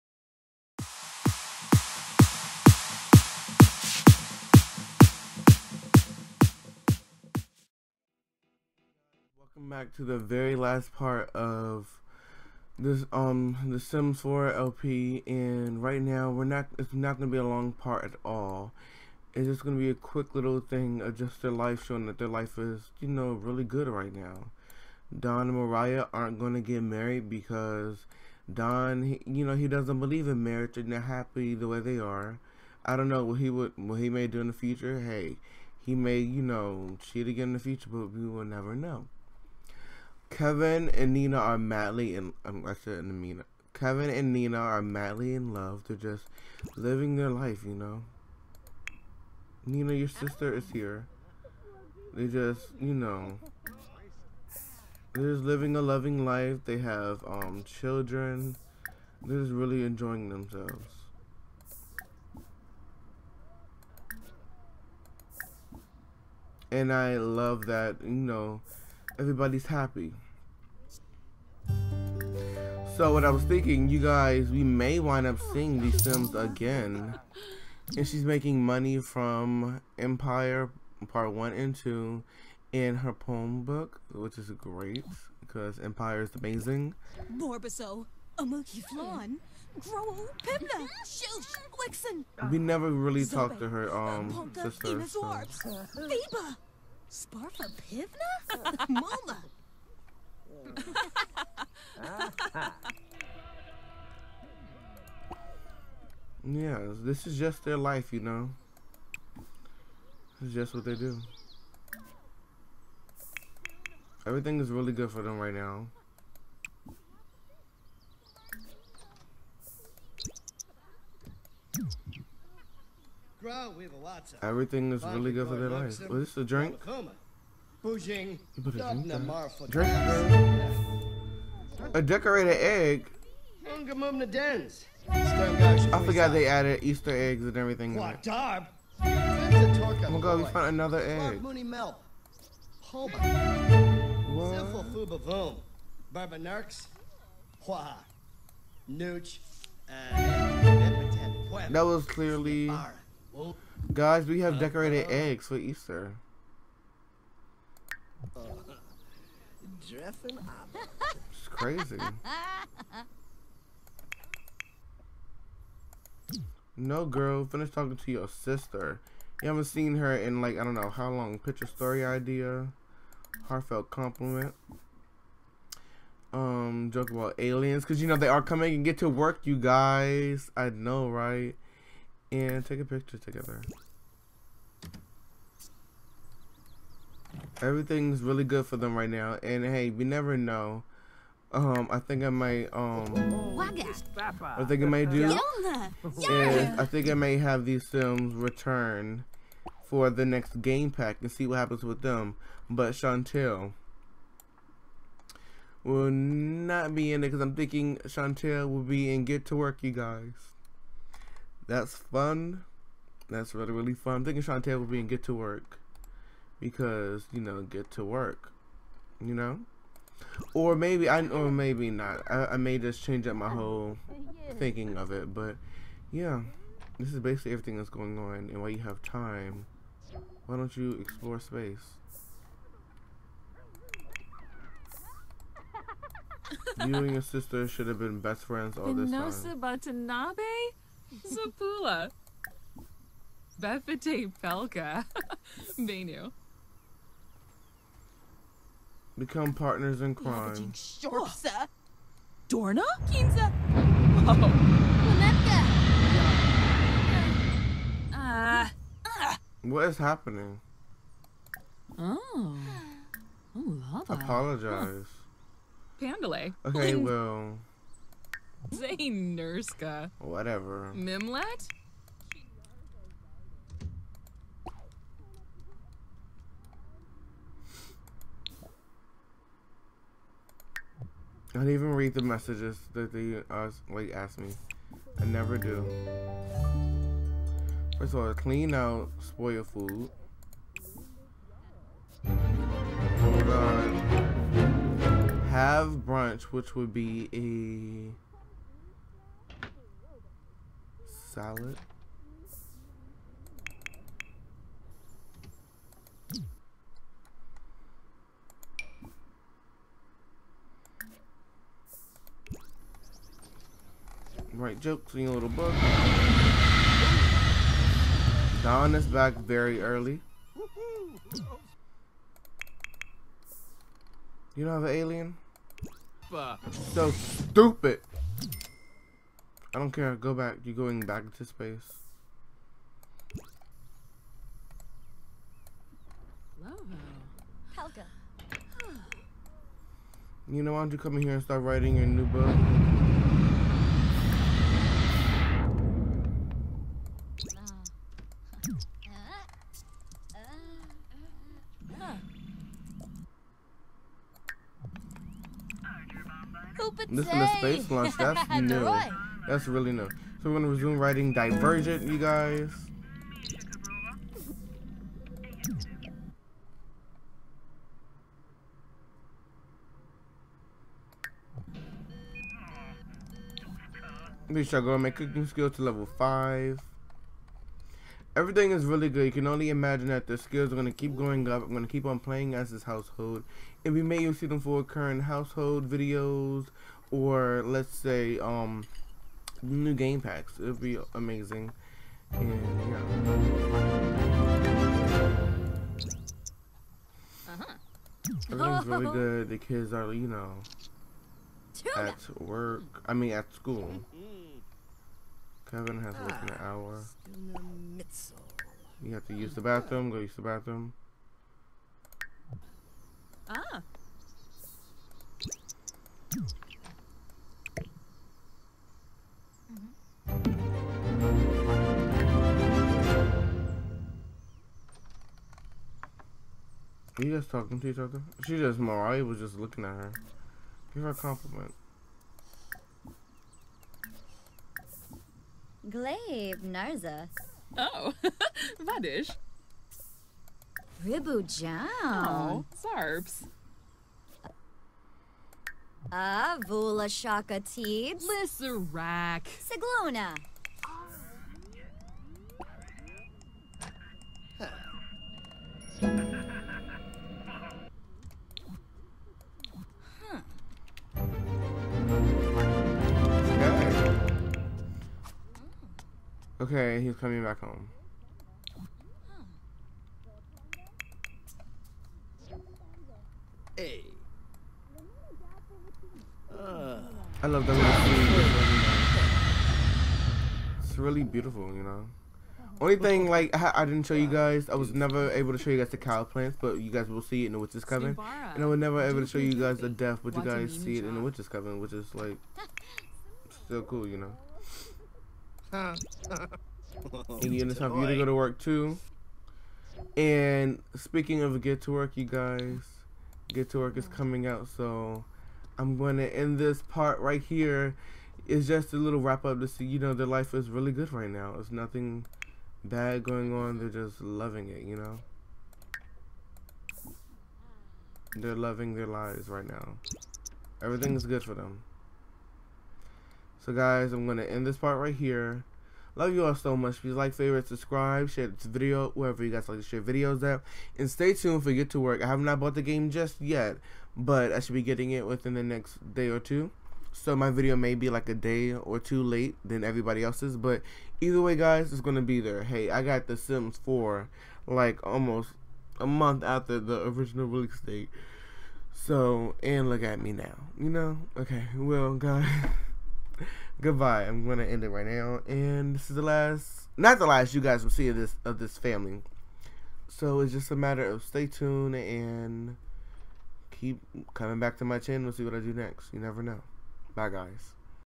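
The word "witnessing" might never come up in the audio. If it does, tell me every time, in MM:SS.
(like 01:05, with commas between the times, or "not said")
not said.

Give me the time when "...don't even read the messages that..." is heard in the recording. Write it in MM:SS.
04:41.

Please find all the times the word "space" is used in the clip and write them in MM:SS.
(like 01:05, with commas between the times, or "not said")
03:51, 05:31, 05:57.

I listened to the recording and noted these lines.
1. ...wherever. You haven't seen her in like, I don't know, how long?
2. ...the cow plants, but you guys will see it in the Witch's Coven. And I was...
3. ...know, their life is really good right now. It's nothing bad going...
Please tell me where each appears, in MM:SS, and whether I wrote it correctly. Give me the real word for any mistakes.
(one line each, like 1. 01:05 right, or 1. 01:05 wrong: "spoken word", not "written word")
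1. 02:48 wrong: "sister", not "wherever"
2. 08:05 right
3. 08:29 right.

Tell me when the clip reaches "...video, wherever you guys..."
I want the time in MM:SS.
08:48.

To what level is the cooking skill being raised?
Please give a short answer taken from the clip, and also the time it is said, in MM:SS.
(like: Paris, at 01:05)
5, at 06:15.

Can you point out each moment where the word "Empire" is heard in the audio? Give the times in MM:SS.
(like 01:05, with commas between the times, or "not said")
01:19, 01:25.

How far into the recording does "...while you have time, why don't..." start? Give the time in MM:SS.
03:48.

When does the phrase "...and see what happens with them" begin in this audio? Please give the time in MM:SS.
03:21.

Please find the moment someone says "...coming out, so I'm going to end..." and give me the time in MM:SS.
08:24.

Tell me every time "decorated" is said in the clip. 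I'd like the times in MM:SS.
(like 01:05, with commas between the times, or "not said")
02:12, 02:34.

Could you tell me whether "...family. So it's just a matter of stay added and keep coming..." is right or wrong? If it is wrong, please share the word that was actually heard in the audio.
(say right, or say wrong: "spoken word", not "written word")
wrong: "tuned", not "added".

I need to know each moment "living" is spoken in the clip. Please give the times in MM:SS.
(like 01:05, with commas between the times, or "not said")
00:46, 00:55.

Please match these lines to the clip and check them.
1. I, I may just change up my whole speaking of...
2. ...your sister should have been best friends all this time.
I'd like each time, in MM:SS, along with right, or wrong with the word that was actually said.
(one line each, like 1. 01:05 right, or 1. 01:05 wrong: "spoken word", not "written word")
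1. 03:42 wrong: "thinking", not "speaking"
2. 03:57 right.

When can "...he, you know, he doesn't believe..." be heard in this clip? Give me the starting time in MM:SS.
00:29.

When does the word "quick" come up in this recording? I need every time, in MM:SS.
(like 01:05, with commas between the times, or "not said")
00:19.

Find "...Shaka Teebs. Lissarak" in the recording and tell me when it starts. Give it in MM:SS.
07:27.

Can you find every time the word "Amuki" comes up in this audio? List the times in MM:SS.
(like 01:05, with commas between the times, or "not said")
01:28.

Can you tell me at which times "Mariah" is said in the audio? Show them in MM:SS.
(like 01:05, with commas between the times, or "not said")
00:25, 07:08.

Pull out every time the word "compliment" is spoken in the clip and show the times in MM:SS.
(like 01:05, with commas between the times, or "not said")
02:53, 07:11.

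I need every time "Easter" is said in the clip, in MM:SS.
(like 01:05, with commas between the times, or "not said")
02:16, 02:35.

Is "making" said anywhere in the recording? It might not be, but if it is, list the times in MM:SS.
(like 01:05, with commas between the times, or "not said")
01:18.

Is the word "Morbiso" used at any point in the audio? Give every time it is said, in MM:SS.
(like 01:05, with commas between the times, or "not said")
01:27.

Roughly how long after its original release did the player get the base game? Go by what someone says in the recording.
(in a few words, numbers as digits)
Almost a month.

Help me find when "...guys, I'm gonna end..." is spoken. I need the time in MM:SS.
08:43.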